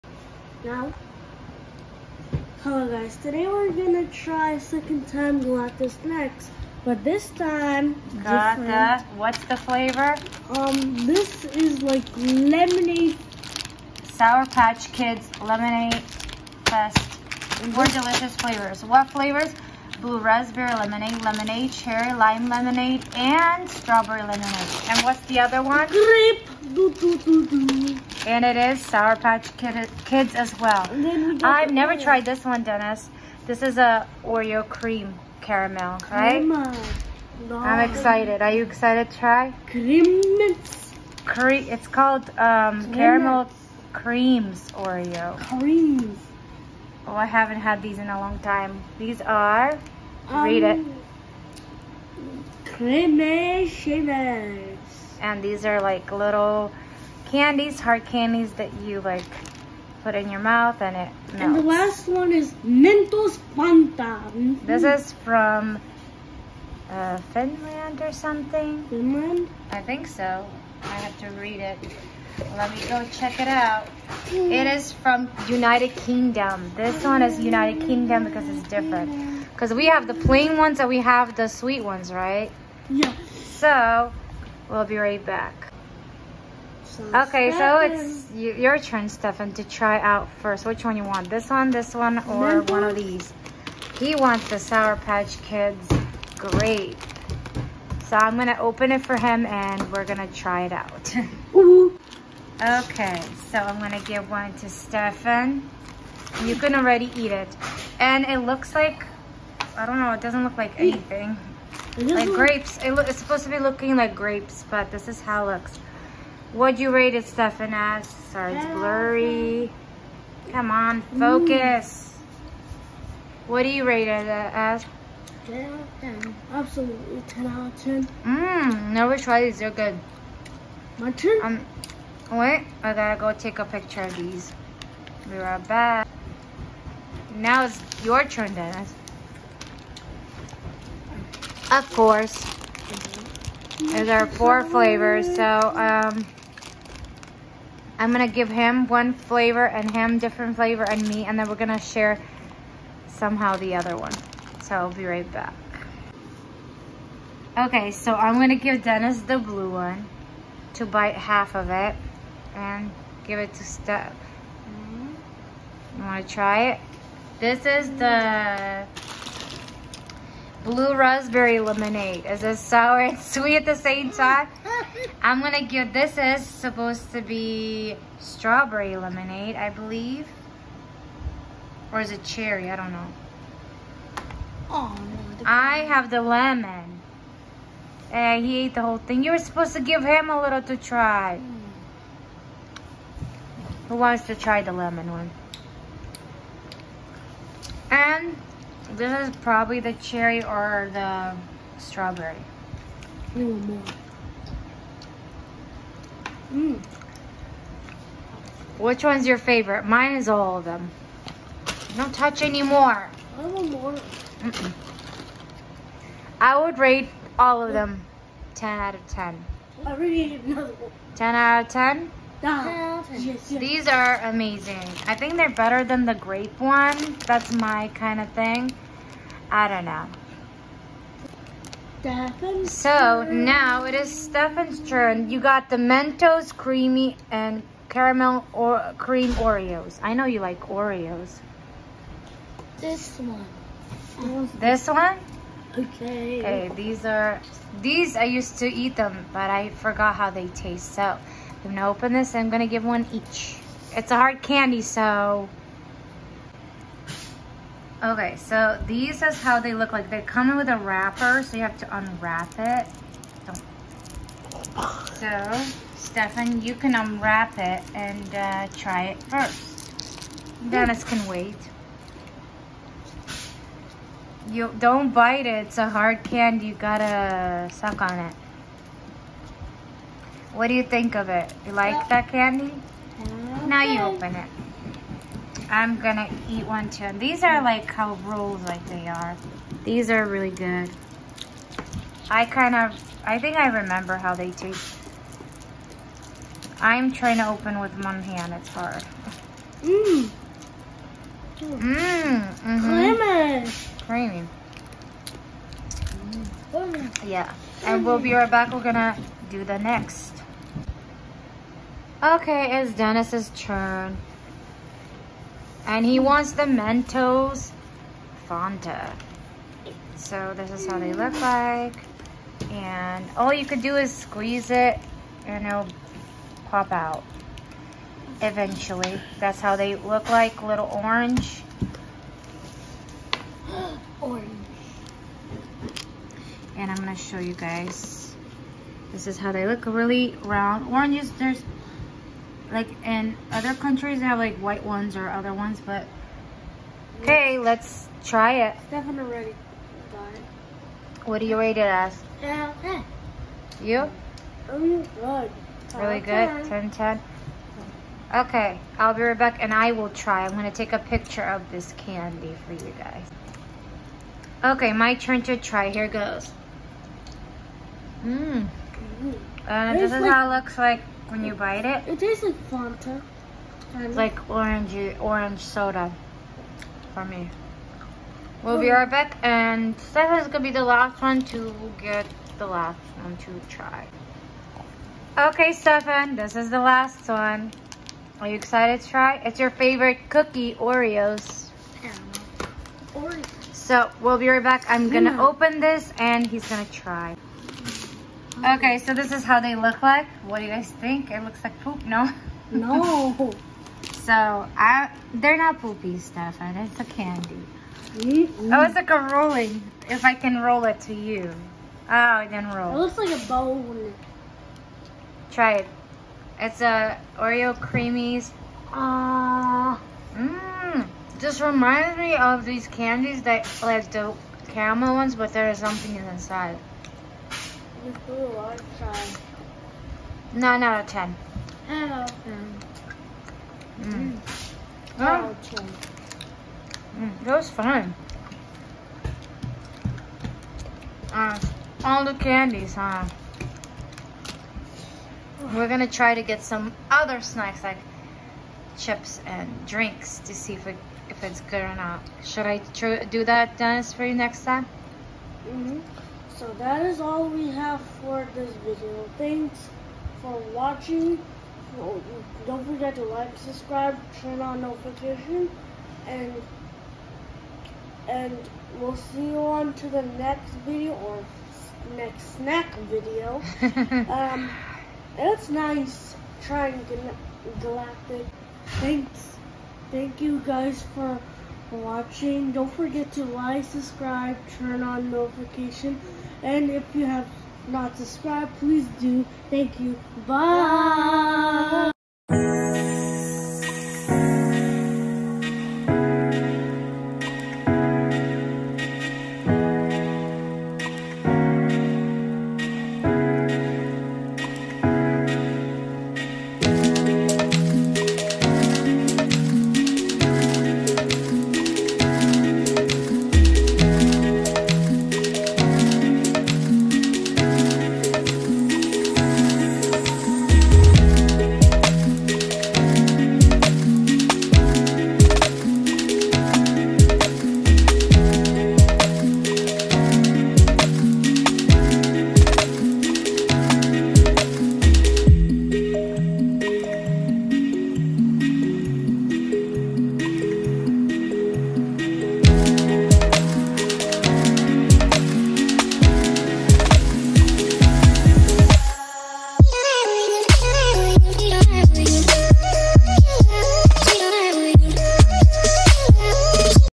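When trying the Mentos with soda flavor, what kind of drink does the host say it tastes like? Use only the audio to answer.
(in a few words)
Orange soda.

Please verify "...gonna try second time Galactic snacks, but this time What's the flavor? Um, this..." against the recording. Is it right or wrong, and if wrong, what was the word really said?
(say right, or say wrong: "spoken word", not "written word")
right.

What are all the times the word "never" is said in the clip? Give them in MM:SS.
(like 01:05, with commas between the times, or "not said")
00:31, 02:08.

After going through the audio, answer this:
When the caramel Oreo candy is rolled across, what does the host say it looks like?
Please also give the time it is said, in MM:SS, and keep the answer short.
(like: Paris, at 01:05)
A bone, at 06:53.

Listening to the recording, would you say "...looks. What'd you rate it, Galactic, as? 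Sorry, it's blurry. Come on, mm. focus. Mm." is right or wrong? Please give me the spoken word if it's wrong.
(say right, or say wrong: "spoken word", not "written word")
wrong: "Stefan", not "Galactic".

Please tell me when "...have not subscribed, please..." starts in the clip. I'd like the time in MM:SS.
08:07.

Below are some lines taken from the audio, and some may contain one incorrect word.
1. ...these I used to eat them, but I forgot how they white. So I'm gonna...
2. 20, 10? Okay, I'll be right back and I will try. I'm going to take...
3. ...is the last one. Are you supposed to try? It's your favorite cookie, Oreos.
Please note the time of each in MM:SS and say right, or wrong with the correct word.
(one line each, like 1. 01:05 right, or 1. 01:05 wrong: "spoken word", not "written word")
1. 04:07 wrong: "taste", not "white"
2. 05:56 wrong: "10", not "20"
3. 06:26 wrong: "excited", not "supposed".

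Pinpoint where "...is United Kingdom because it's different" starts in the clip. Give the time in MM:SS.
01:17.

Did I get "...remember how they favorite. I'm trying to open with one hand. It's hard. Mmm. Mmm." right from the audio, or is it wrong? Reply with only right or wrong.
wrong.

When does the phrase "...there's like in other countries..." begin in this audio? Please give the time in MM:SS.
05:41.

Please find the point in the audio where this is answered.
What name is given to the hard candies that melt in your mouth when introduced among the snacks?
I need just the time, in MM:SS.
00:52.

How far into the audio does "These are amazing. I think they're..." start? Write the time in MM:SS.
03:43.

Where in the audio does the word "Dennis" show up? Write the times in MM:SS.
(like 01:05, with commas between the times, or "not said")
00:32, 02:18, 02:38, 04:30, 05:12, 07:33.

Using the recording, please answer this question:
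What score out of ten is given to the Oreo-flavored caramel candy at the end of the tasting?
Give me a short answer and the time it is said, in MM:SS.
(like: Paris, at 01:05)
9 out of 10, at 07:10.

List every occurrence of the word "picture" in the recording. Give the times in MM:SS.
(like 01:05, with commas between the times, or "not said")
02:13, 06:00.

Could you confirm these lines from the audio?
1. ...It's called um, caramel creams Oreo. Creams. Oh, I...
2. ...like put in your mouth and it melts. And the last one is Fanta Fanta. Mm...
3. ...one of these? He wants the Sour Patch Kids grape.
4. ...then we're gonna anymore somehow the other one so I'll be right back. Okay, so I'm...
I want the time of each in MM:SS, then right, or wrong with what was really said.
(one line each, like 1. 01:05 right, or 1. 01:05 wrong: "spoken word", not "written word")
1. 00:41 right
2. 00:59 wrong: "Mentos", not "Fanta"
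3. 01:32 right
4. 02:31 wrong: "share", not "anymore".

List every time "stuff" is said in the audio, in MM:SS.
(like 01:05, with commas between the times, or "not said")
06:46.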